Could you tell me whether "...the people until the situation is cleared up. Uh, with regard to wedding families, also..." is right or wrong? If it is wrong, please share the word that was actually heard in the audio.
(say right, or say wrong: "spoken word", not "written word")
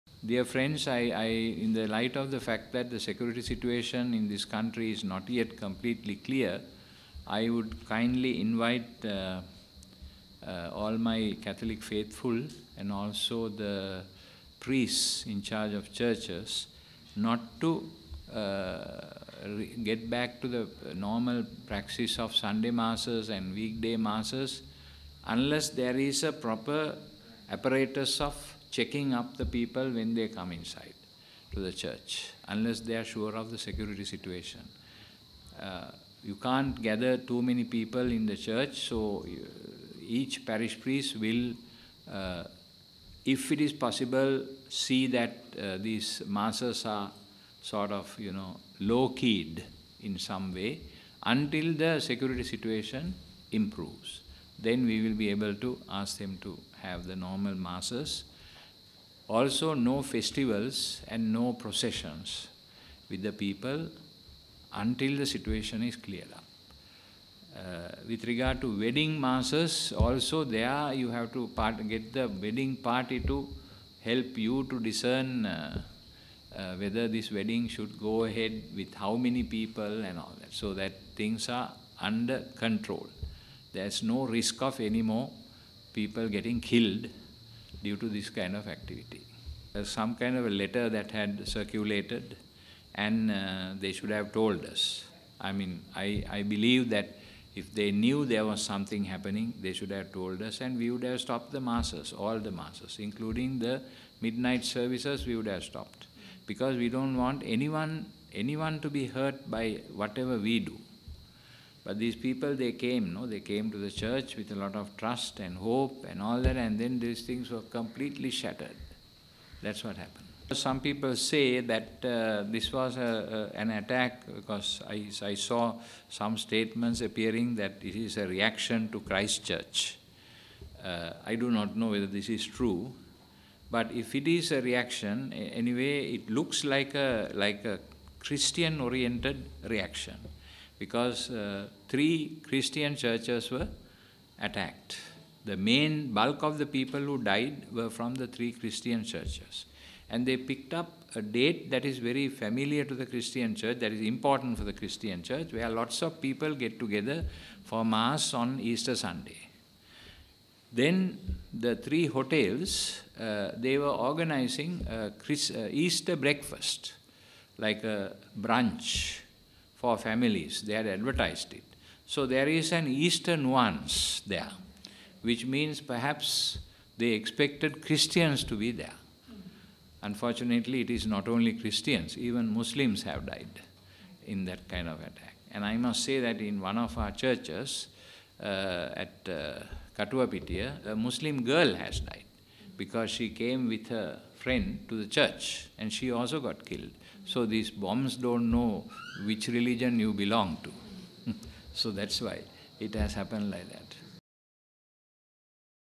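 wrong: "masses", not "families".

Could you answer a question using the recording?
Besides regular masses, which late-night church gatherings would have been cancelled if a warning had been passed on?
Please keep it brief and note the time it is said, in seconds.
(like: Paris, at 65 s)
midnight services, at 104 s.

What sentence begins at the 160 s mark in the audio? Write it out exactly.
Then the three hotels, uh, they were organizing Chris, uh, Easter breakfast, like a brunch for families.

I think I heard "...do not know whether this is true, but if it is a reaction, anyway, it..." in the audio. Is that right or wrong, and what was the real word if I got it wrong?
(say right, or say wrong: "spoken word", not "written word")
right.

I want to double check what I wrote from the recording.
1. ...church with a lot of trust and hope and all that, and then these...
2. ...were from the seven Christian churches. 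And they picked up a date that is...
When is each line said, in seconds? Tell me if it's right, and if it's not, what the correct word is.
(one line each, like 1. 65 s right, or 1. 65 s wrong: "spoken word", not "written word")
1. 113 s right
2. 147 s wrong: "three", not "seven".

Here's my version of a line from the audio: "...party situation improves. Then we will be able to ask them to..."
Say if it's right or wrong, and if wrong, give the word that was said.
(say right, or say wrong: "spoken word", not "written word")
wrong: "security", not "party".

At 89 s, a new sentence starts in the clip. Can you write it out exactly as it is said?
some kind of a letter that had circulated and uh, they should have told us.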